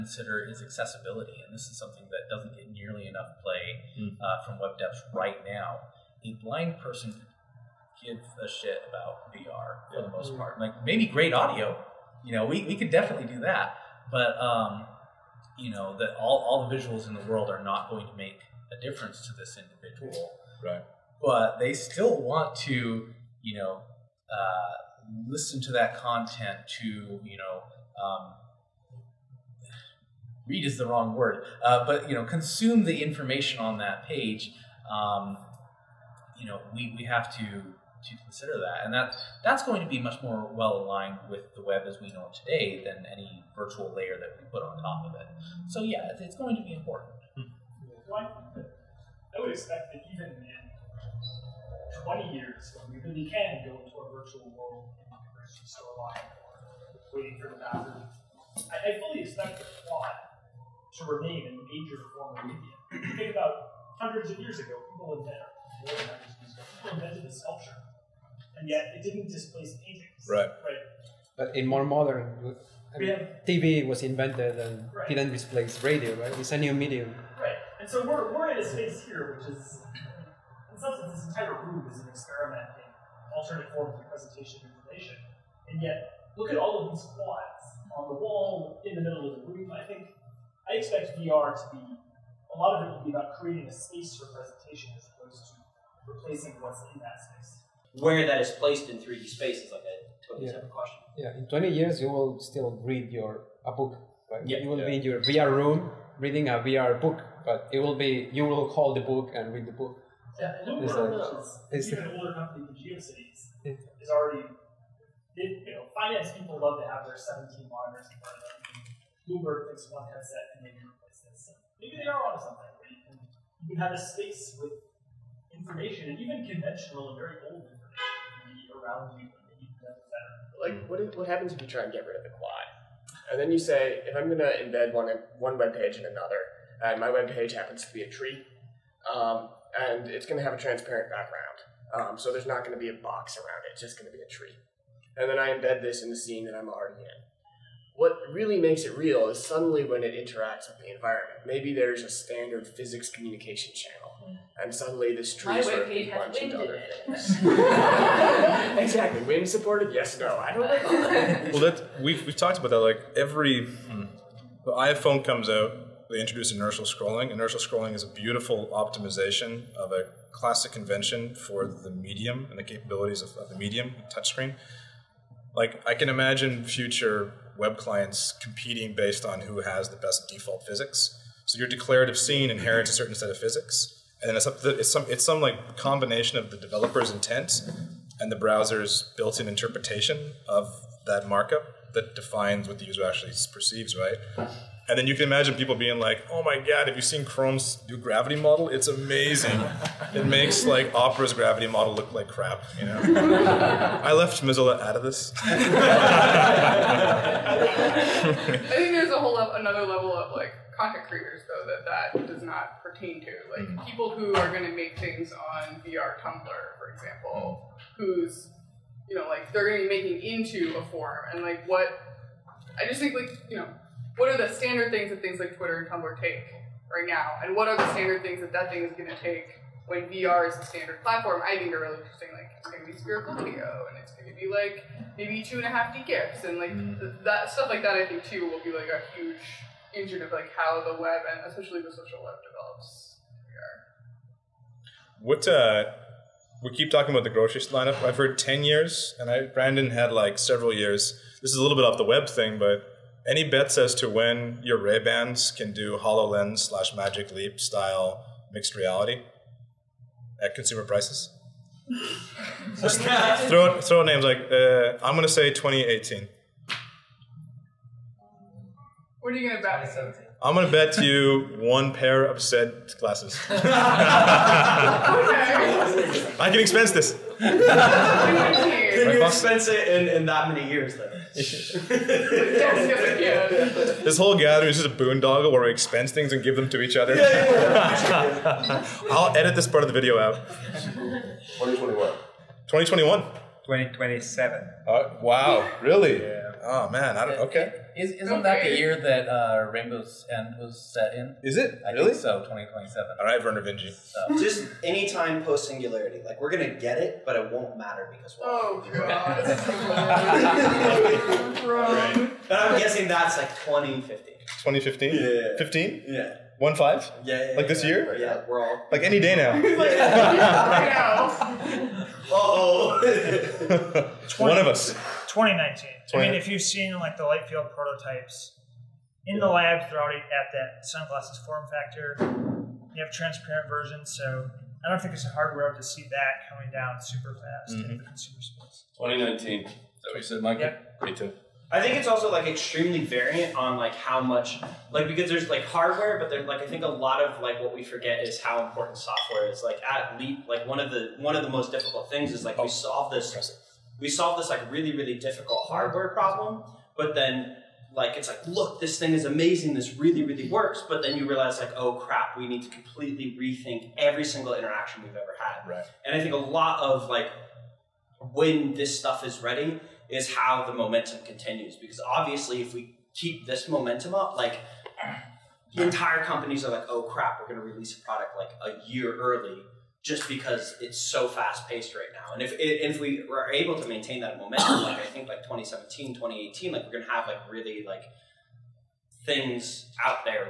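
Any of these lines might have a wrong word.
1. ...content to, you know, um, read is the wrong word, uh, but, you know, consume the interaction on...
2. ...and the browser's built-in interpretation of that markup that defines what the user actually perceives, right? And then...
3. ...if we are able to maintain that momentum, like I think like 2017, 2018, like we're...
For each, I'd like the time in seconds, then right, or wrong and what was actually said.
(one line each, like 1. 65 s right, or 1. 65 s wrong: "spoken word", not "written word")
1. 25 s wrong: "information", not "interaction"
2. 188 s right
3. 382 s right.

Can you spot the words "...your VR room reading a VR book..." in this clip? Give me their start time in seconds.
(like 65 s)
105 s.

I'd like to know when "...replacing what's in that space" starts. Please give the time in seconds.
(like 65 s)
96 s.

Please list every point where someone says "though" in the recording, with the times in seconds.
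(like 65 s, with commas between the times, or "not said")
211 s, 280 s.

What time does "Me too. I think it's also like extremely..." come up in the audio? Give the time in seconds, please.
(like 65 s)
341 s.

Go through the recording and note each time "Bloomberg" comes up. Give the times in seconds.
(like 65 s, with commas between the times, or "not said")
119 s.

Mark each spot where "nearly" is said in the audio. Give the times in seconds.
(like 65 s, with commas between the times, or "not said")
2 s.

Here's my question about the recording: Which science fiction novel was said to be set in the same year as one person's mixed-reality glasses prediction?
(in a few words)
Rainbow's End.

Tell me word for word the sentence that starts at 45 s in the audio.
So, yeah, it's, it's going to be important.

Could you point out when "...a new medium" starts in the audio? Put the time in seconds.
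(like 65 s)
76 s.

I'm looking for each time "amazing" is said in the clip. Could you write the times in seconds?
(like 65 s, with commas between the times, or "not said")
198 s, 359 s.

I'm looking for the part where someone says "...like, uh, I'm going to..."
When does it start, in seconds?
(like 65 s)
264 s.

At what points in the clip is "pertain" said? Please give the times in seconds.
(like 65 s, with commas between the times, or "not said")
212 s.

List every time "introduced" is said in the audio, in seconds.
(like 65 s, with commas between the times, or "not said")
166 s.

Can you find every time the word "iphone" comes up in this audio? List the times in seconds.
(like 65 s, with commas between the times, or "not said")
164 s.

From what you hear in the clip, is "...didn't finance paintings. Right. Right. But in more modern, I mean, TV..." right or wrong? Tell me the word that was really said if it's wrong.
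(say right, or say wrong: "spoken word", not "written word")
wrong: "displace", not "finance".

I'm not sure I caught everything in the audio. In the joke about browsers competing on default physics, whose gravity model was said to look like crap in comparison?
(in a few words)
Opera's.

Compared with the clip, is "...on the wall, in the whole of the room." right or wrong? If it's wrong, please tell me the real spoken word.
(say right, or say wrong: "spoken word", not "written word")
wrong: "middle", not "whole".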